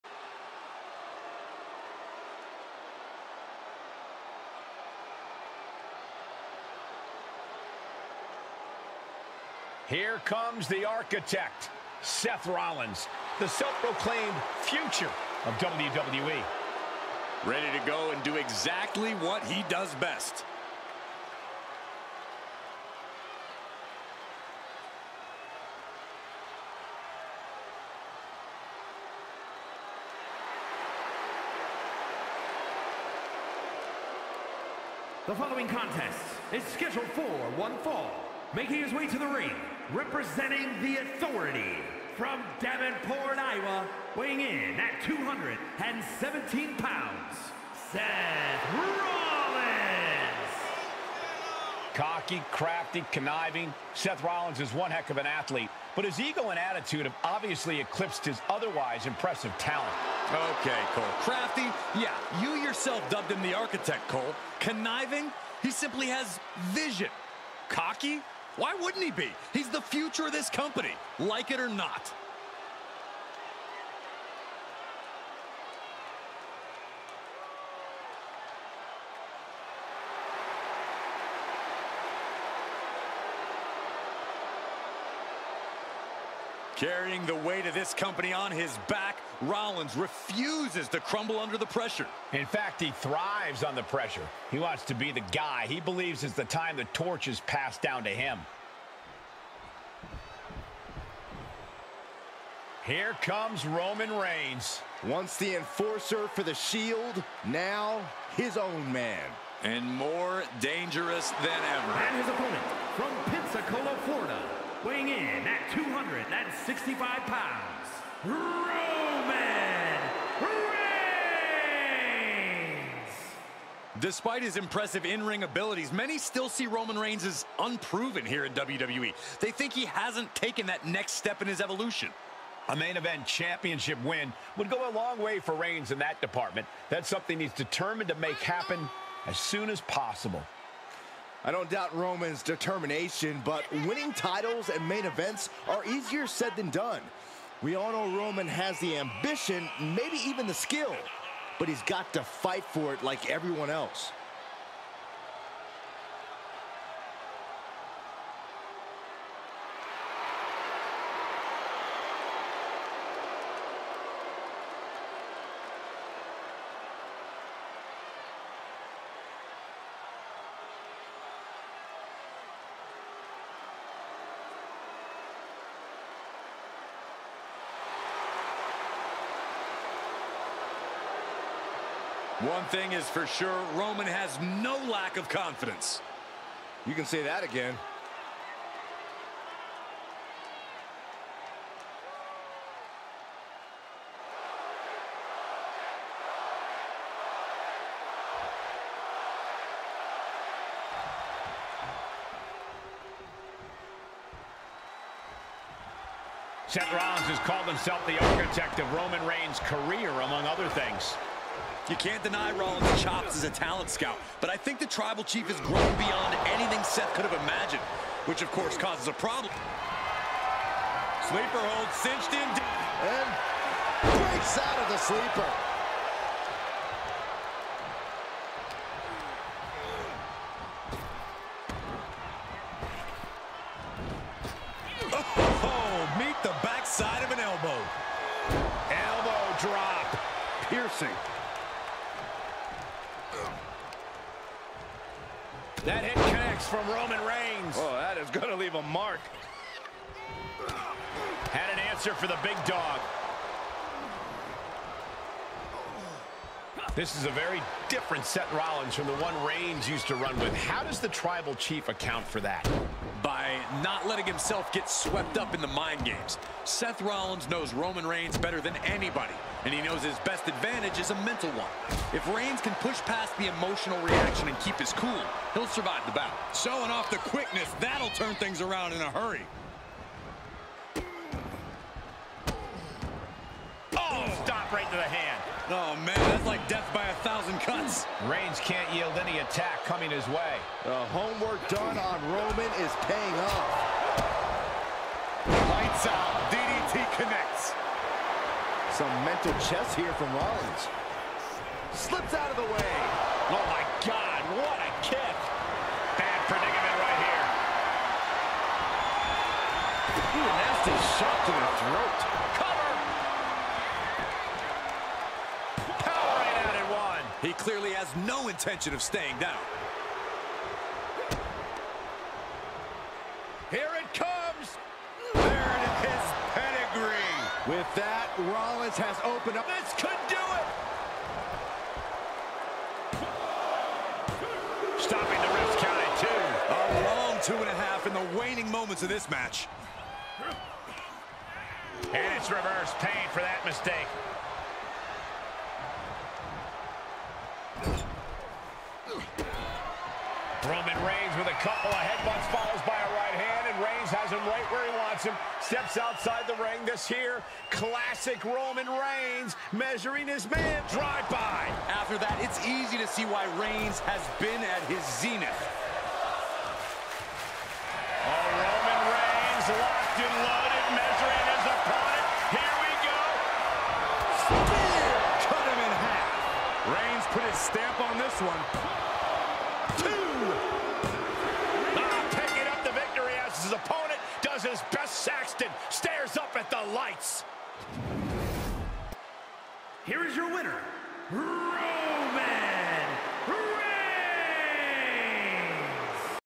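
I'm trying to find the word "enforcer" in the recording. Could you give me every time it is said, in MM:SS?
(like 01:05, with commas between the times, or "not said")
01:45.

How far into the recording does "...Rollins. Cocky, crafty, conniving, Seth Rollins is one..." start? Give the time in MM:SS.
00:48.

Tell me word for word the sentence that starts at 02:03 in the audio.
Despite his impressive in-ring abilities, many still see Roman Reigns as unproven here in WWE.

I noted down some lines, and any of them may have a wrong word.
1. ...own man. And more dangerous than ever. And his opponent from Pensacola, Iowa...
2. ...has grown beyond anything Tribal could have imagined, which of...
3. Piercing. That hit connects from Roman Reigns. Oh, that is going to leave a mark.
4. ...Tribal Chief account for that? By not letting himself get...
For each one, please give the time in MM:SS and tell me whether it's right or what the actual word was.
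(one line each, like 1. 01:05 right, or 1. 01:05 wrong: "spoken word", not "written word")
1. 01:48 wrong: "Florida", not "Iowa"
2. 03:35 wrong: "Seth", not "Tribal"
3. 04:00 right
4. 04:21 right.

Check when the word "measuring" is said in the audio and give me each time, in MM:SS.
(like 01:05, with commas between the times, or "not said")
05:59, 06:10.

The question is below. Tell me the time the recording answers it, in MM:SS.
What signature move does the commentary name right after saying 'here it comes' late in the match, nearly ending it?
05:26.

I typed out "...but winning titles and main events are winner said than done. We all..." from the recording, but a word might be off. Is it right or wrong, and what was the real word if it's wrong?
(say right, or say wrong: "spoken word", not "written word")
wrong: "easier", not "winner".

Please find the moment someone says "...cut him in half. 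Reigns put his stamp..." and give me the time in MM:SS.
06:15.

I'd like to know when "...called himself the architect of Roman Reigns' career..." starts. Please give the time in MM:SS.
03:27.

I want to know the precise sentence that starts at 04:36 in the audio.
Showing off the quickness, that'll turn things around in a hurry.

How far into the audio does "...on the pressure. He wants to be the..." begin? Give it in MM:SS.
01:33.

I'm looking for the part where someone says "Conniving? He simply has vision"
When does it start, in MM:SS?
01:04.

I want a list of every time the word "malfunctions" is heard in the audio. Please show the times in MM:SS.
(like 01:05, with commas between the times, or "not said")
not said.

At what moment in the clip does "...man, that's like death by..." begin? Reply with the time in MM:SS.
04:46.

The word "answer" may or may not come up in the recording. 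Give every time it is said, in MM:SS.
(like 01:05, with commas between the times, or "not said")
04:11.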